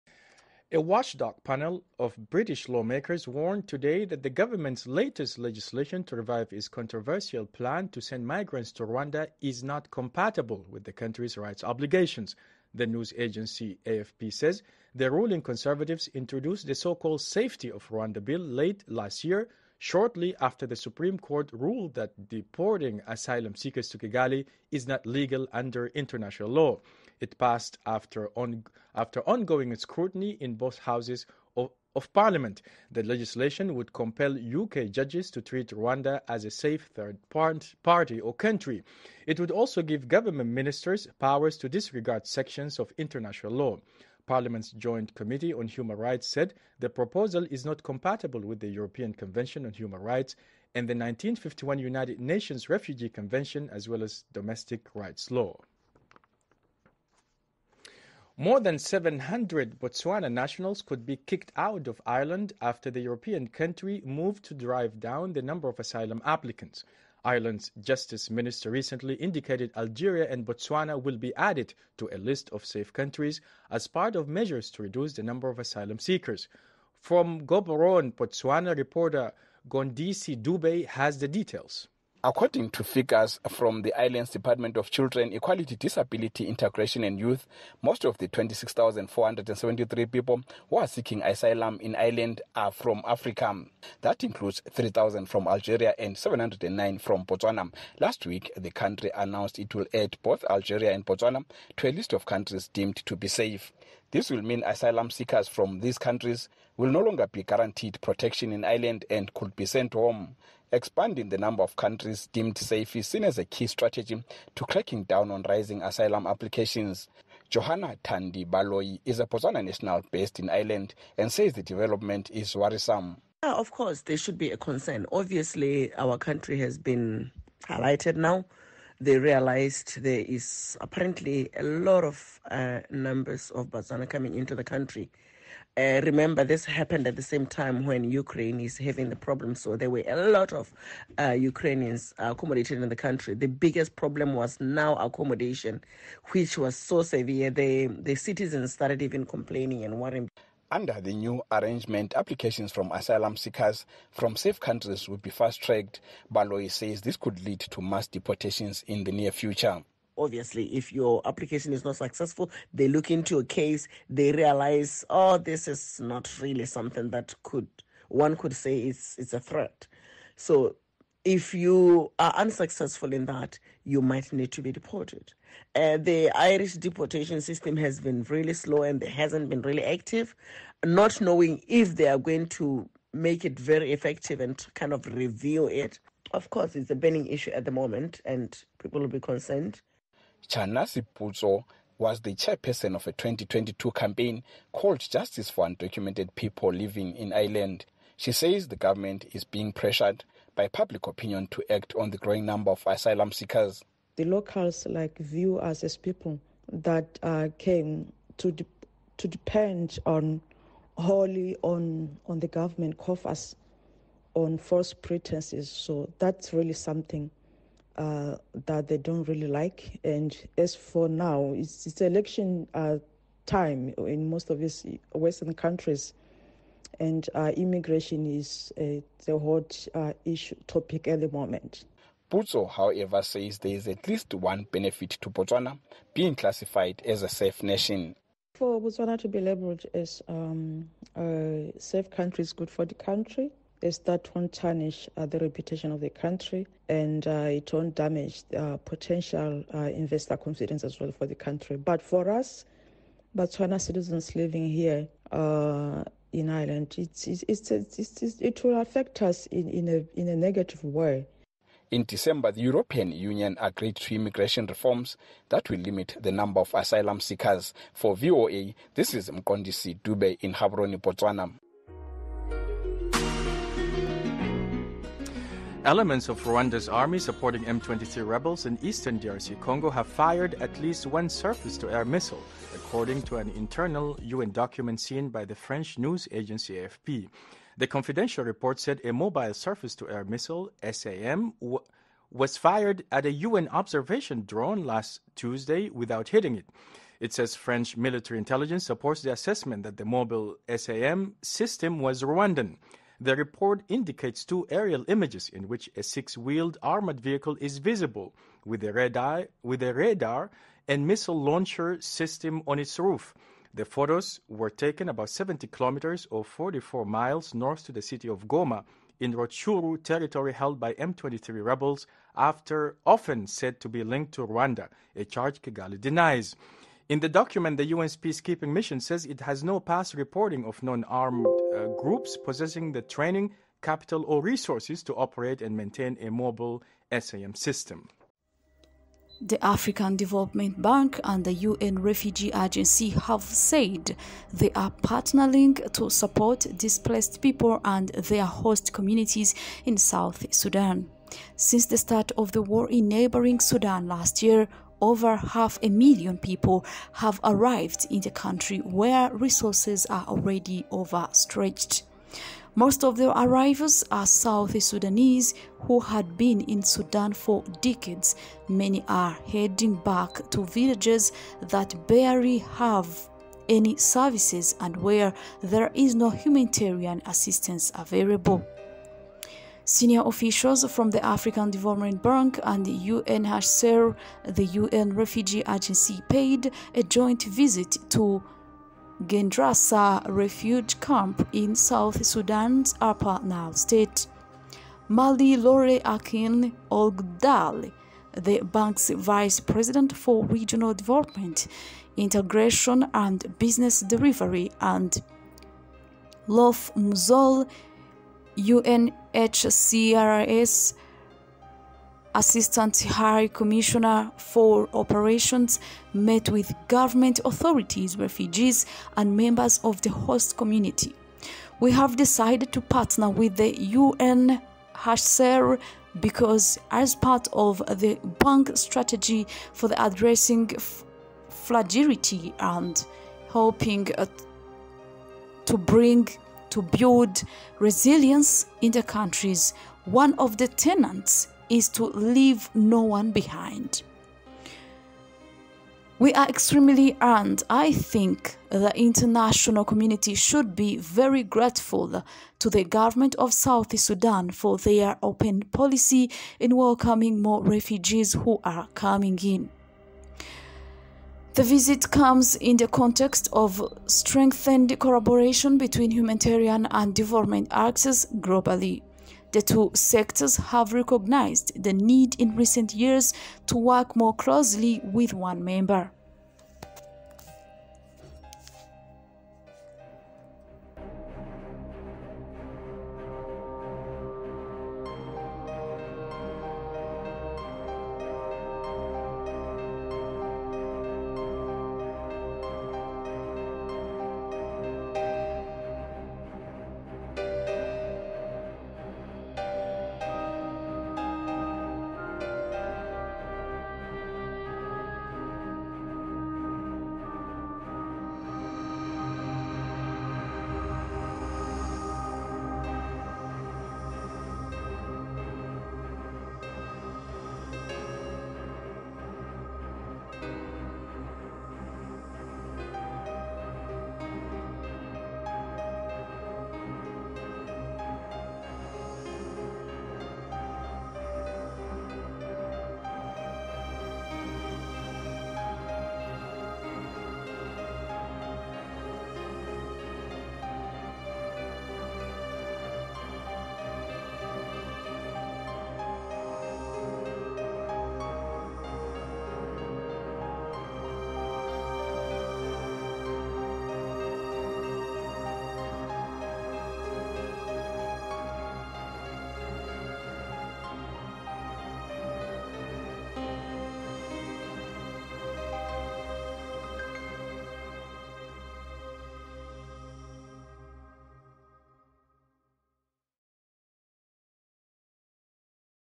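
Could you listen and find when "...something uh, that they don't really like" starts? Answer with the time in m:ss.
3:36.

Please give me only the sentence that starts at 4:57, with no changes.
It says French military intelligence supports the assessment that the mobile SAM system was Rwandan.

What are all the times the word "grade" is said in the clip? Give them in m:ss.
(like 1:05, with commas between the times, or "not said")
not said.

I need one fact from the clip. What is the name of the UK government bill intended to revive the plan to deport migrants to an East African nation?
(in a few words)
Safety of Rwanda Bill.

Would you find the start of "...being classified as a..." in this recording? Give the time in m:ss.
3:56.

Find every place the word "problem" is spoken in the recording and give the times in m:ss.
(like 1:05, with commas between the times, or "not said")
2:19, 2:23.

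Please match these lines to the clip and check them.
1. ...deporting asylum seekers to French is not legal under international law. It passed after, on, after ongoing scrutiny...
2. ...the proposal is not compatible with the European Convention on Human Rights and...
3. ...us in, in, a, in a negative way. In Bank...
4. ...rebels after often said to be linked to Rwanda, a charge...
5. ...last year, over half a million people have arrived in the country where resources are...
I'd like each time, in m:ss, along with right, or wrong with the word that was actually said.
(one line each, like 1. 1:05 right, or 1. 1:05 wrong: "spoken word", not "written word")
1. 0:22 wrong: "Kigali", not "French"
2. 0:46 right
3. 4:19 wrong: "December", not "Bank"
4. 5:21 right
5. 5:54 right.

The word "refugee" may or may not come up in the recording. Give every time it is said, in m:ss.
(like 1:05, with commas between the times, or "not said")
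0:52, 5:41, 6:25, 6:30, 6:58, 7:37.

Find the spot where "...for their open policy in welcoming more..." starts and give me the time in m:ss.
7:34.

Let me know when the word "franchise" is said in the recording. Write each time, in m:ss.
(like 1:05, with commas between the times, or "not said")
not said.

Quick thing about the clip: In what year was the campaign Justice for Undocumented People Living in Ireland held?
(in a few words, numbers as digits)
2022.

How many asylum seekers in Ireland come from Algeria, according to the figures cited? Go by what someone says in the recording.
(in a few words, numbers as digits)
3,000.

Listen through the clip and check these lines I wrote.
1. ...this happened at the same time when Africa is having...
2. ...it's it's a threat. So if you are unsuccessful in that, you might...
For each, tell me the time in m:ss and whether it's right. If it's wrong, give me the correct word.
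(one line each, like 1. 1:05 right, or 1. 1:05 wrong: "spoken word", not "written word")
1. 2:16 wrong: "Ukraine", not "Africa"
2. 2:48 right.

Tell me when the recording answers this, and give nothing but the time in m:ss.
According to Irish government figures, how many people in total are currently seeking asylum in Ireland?
1:28.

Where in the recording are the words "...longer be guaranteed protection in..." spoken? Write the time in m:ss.
1:46.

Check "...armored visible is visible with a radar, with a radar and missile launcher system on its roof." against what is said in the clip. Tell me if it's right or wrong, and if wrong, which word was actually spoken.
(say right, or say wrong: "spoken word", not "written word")
wrong: "vehicle", not "visible".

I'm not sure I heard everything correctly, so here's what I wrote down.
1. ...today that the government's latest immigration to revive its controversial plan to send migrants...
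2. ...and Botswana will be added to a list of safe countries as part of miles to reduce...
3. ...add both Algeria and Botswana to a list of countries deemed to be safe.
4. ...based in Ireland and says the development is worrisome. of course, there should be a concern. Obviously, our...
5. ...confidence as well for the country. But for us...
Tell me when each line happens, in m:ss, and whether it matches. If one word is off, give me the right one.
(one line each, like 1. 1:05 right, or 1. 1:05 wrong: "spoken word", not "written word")
1. 0:03 wrong: "legislation", not "immigration"
2. 1:10 wrong: "measures", not "miles"
3. 1:39 right
4. 2:00 right
5. 4:10 right.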